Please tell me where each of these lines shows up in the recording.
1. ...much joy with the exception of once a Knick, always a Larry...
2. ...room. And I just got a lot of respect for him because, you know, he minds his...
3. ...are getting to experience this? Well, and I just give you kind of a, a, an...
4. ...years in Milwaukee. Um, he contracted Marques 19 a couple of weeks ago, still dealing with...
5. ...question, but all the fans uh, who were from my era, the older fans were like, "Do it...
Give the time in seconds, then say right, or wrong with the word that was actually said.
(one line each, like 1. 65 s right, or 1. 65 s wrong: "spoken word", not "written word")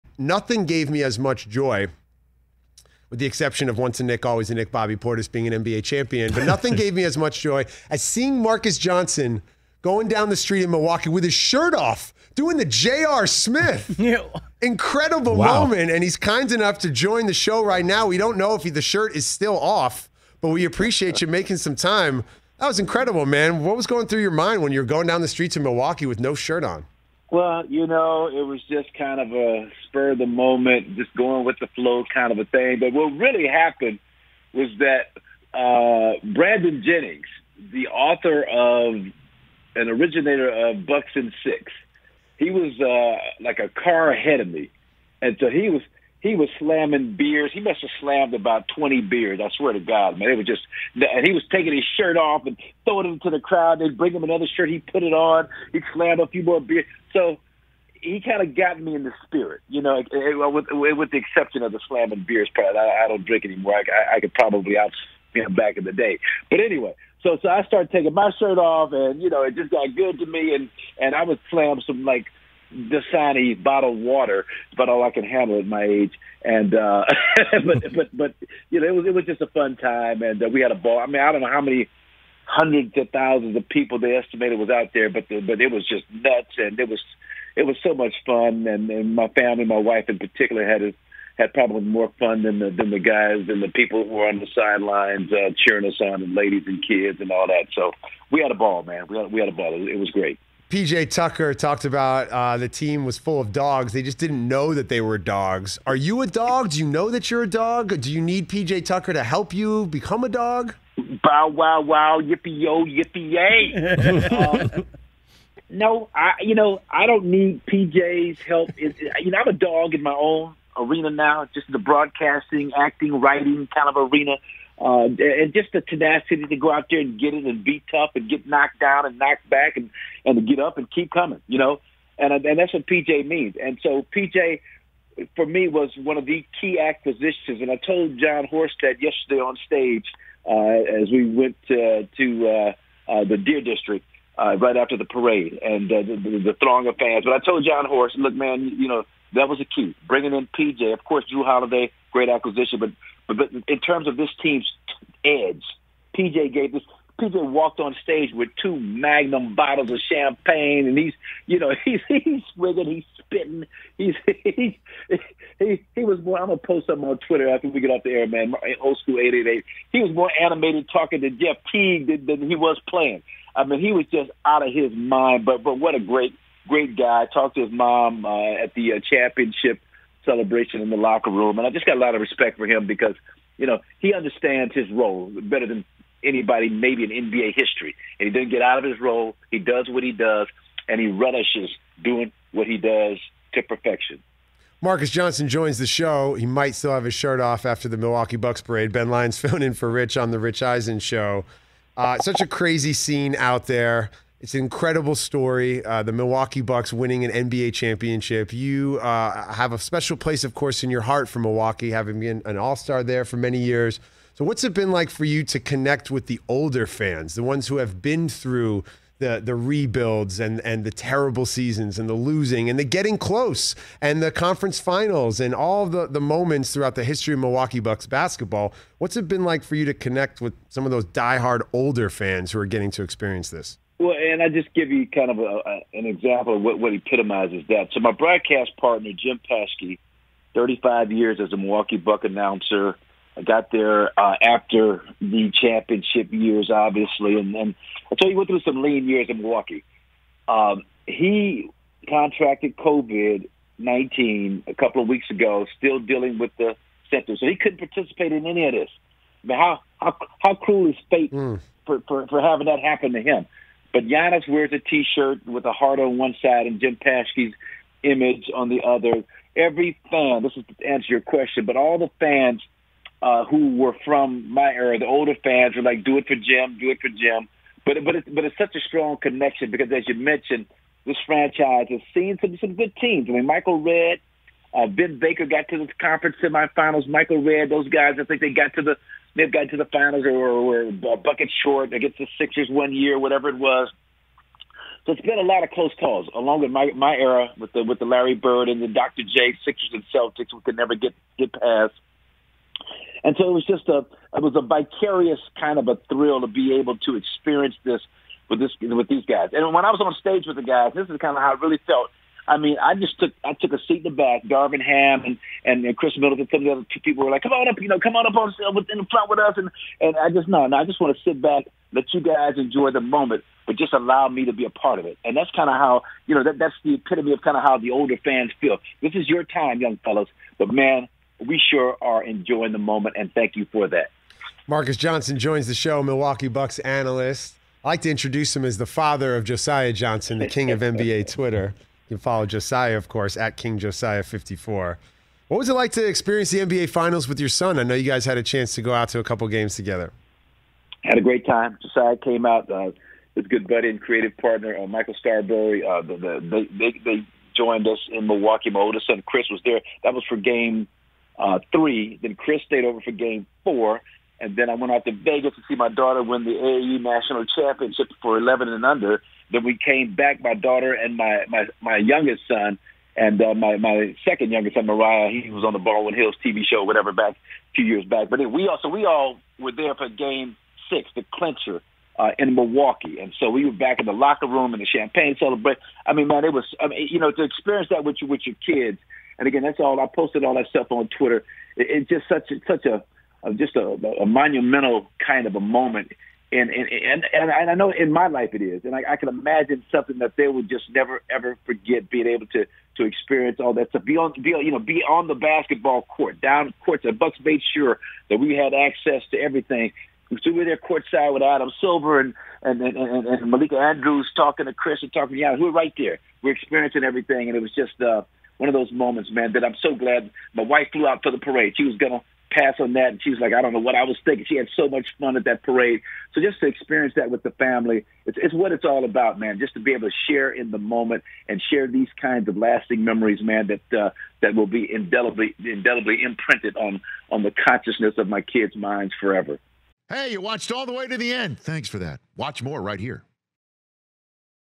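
1. 1 s wrong: "Knick", not "Larry"
2. 181 s wrong: "understands", not "minds"
3. 232 s right
4. 249 s wrong: "COVID", not "Marques"
5. 271 s right.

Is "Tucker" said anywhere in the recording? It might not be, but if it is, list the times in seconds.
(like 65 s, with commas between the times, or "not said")
101 s, 108 s.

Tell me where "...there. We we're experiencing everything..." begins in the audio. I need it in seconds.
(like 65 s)
415 s.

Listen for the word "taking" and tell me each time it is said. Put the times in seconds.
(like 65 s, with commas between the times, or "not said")
51 s, 67 s.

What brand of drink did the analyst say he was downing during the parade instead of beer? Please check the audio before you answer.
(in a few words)
Dasani.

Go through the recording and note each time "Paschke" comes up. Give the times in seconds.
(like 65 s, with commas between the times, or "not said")
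239 s, 266 s.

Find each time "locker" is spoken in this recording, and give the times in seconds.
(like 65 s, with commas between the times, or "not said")
180 s, 384 s.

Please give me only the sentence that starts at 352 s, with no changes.
Uh, his good buddy and creative partner, uh, Michael Starrbury, uh, the, the, they, they joined us in Milwaukee.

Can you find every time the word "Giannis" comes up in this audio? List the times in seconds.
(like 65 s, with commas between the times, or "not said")
264 s, 415 s.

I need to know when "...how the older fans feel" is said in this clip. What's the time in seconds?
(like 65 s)
327 s.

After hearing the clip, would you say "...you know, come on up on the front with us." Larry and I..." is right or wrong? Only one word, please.
wrong.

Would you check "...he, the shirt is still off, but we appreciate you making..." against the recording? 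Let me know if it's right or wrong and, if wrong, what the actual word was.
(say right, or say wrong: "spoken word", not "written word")
right.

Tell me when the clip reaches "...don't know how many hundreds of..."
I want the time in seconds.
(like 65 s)
81 s.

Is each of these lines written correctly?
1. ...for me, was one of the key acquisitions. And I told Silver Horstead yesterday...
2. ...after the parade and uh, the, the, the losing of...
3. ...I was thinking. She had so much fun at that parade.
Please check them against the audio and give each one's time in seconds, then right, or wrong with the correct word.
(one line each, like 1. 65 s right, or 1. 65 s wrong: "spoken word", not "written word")
1. 135 s wrong: "John", not "Silver"
2. 144 s wrong: "throng", not "losing"
3. 423 s right.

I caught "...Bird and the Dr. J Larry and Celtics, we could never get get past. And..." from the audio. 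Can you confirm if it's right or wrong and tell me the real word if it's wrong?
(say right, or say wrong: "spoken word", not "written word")
wrong: "Sixers", not "Larry".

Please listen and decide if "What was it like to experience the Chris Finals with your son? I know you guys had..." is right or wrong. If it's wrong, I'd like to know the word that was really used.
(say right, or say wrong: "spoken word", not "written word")
wrong: "NBA", not "Chris".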